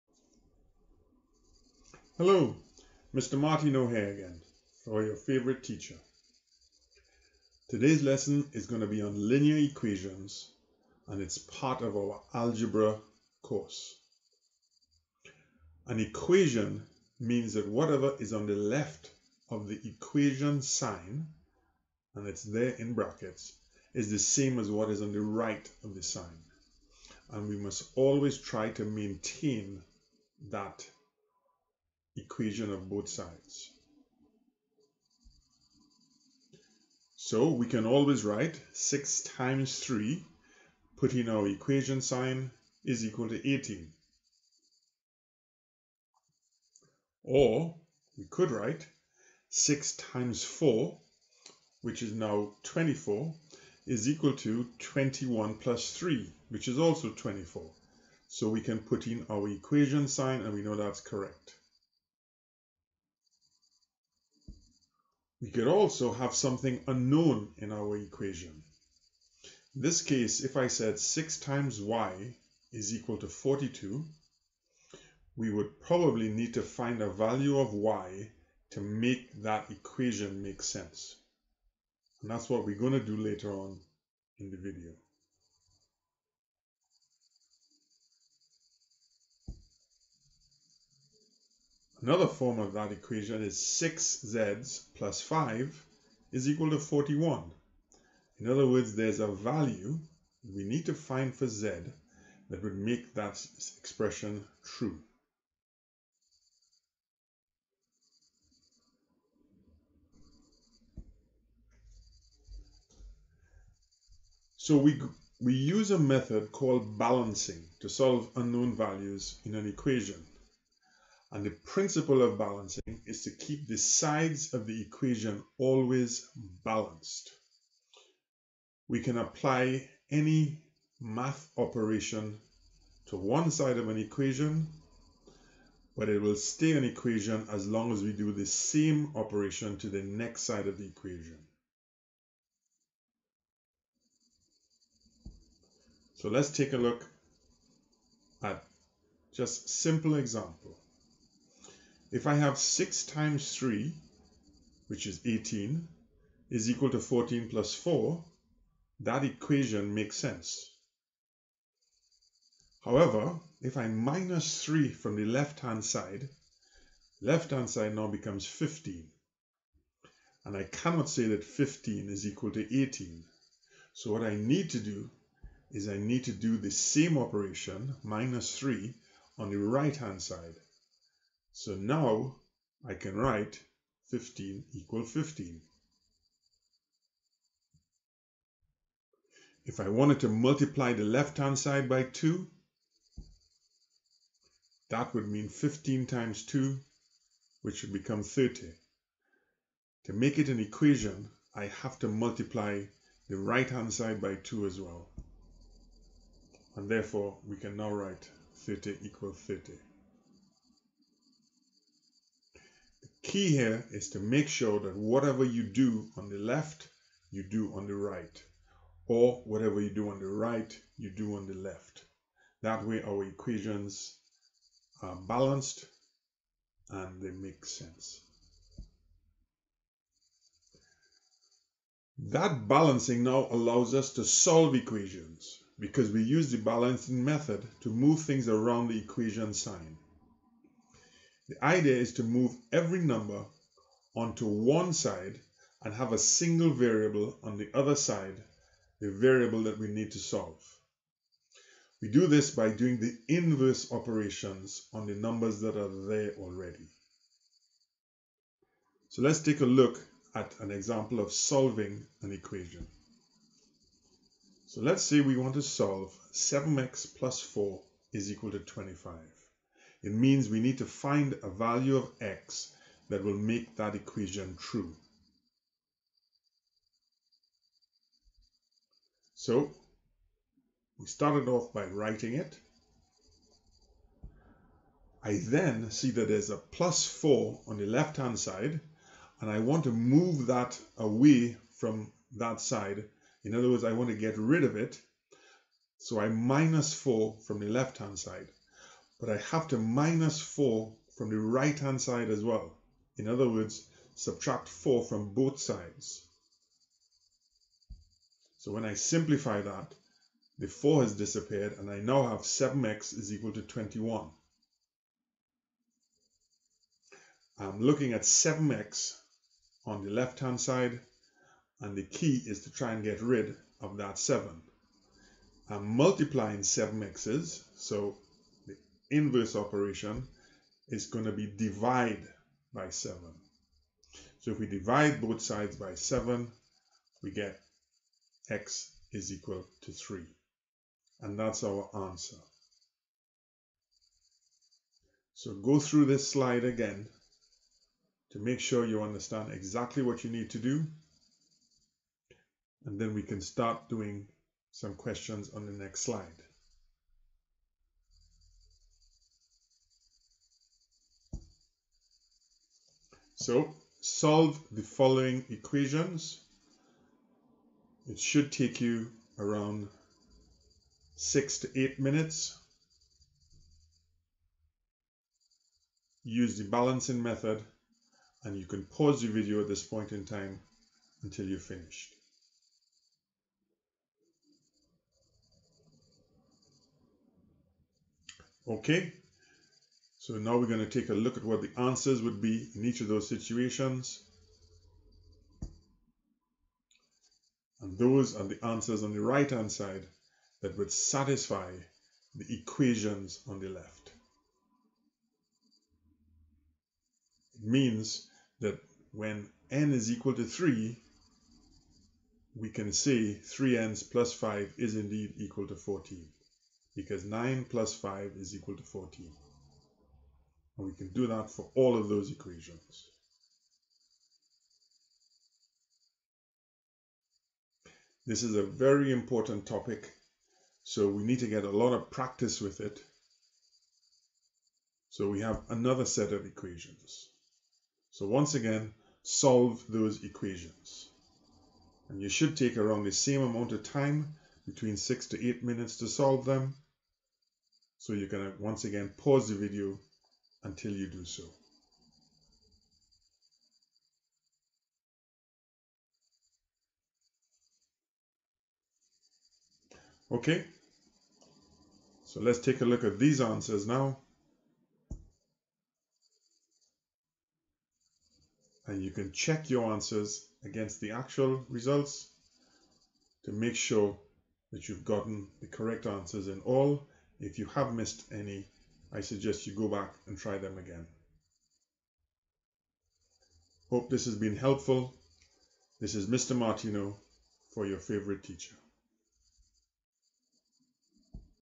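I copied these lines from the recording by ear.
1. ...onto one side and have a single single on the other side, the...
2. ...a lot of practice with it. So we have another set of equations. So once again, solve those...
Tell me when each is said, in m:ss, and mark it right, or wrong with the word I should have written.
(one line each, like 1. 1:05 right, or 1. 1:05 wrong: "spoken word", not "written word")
1. 4:04 wrong: "variable", not "single"
2. 7:11 right.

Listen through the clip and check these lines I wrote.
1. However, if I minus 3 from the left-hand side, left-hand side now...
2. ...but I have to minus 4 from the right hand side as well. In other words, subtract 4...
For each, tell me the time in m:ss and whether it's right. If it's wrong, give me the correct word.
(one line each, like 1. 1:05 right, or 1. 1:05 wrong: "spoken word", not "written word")
1. 2:42 right
2. 4:59 right.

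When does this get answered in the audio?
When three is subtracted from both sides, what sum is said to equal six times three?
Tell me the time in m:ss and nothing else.
2:36.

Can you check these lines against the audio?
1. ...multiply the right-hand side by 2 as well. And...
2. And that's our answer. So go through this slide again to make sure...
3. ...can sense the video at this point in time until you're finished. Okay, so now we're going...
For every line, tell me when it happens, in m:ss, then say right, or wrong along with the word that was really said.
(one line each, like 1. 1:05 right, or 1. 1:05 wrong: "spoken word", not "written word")
1. 3:22 right
2. 5:41 right
3. 6:18 wrong: "pause", not "sense".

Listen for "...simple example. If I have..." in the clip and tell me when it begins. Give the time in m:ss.
2:29.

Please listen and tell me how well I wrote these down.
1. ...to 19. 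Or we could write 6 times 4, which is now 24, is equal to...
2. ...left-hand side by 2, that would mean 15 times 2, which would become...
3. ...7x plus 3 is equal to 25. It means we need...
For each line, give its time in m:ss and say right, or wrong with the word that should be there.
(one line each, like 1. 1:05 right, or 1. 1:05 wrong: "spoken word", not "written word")
1. 0:43 wrong: "18", not "19"
2. 3:11 right
3. 4:26 wrong: "4", not "3".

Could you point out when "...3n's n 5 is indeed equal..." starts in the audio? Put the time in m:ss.
6:53.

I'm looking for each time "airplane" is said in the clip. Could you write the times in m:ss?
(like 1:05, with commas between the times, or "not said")
not said.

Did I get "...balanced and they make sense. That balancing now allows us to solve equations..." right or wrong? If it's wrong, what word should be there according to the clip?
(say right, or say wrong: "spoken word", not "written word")
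right.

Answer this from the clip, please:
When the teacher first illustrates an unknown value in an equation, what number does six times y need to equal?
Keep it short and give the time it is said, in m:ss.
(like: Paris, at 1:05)
42, at 1:13.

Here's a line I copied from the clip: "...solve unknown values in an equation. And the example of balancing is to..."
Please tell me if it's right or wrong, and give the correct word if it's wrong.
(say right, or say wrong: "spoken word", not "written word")
wrong: "principle", not "example".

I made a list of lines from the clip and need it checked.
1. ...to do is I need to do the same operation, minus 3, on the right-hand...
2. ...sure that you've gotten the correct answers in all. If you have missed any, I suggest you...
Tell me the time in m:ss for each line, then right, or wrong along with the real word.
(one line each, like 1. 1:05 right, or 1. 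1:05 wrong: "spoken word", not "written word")
1. 2:54 right
2. 7:53 right.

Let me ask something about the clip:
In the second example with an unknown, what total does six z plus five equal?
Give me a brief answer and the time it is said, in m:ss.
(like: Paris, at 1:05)
41, at 1:36.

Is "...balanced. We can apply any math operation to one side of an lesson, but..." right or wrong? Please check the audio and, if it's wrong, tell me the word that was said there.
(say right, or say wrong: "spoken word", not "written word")
wrong: "equation", not "lesson".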